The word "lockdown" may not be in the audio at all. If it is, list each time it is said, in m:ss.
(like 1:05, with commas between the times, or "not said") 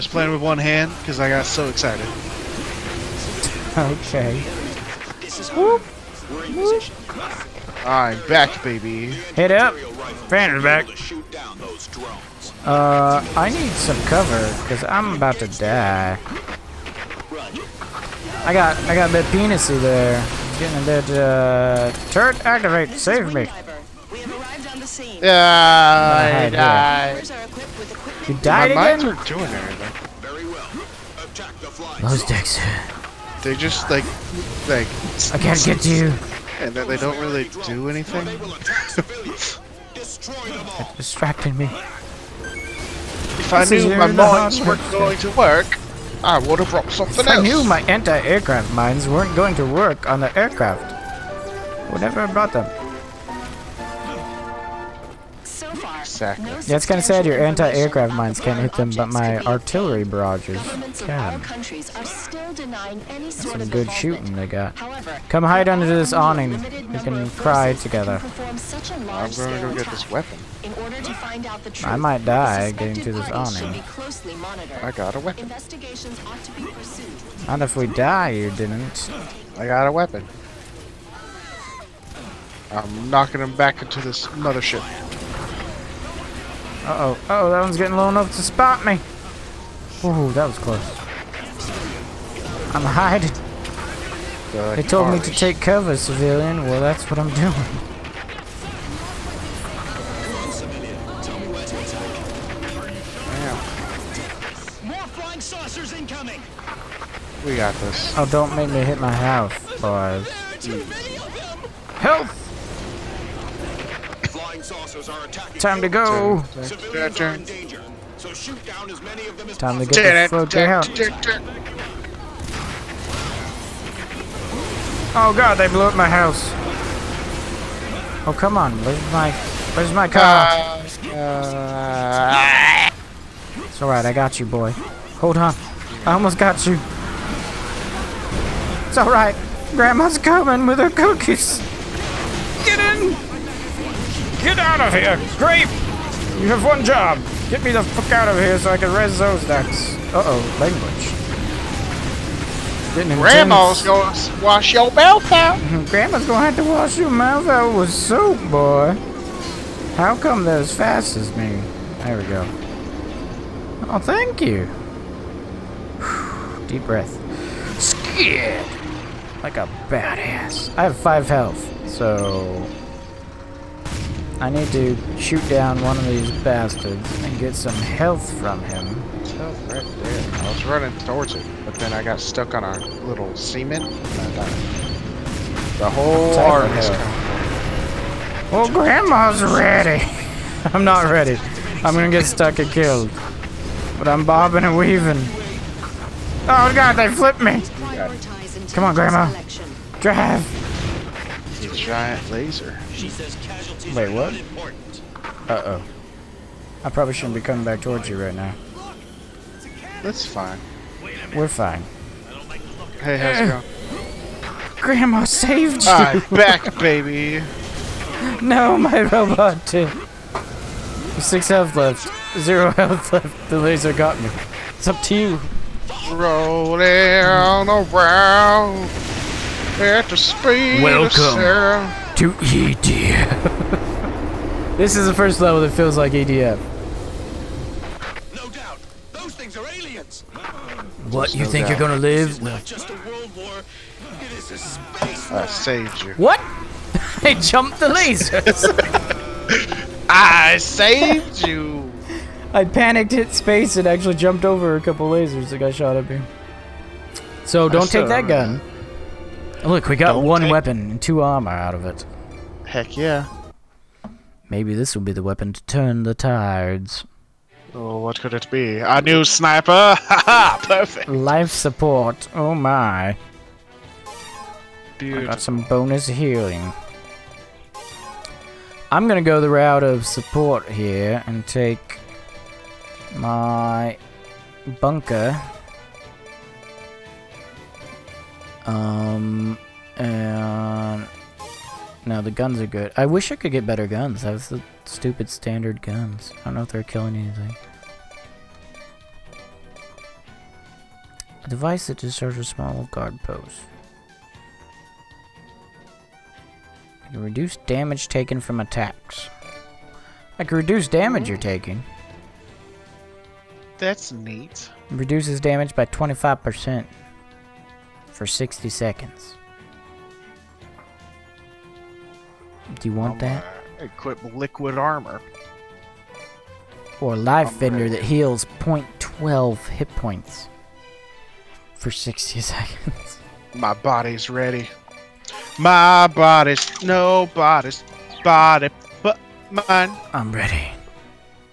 not said.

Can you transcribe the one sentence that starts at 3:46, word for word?
Rolling around at the speed Welcome to EDF.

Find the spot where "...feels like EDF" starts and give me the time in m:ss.
3:55.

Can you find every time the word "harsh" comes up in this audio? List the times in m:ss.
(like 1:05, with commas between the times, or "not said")
1:35.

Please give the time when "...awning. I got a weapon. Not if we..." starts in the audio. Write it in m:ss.
1:13.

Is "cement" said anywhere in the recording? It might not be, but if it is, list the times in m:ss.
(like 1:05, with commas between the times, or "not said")
3:03.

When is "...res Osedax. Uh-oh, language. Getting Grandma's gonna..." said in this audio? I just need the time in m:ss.
2:28.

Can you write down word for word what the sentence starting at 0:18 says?
I got, I got a bit penisy there.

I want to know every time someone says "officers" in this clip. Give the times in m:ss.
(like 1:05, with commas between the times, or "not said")
not said.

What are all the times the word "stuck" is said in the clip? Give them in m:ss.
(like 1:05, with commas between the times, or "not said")
3:02, 3:12.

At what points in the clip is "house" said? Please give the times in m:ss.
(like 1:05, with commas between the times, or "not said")
1:49, 2:06.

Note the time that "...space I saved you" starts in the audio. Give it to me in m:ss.
4:04.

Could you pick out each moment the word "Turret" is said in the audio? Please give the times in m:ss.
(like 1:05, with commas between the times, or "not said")
0:22.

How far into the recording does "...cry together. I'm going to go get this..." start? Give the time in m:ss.
1:07.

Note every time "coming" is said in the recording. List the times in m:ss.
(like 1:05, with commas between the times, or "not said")
2:20, 3:06, 3:27.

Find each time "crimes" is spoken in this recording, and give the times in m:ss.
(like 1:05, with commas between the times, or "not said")
not said.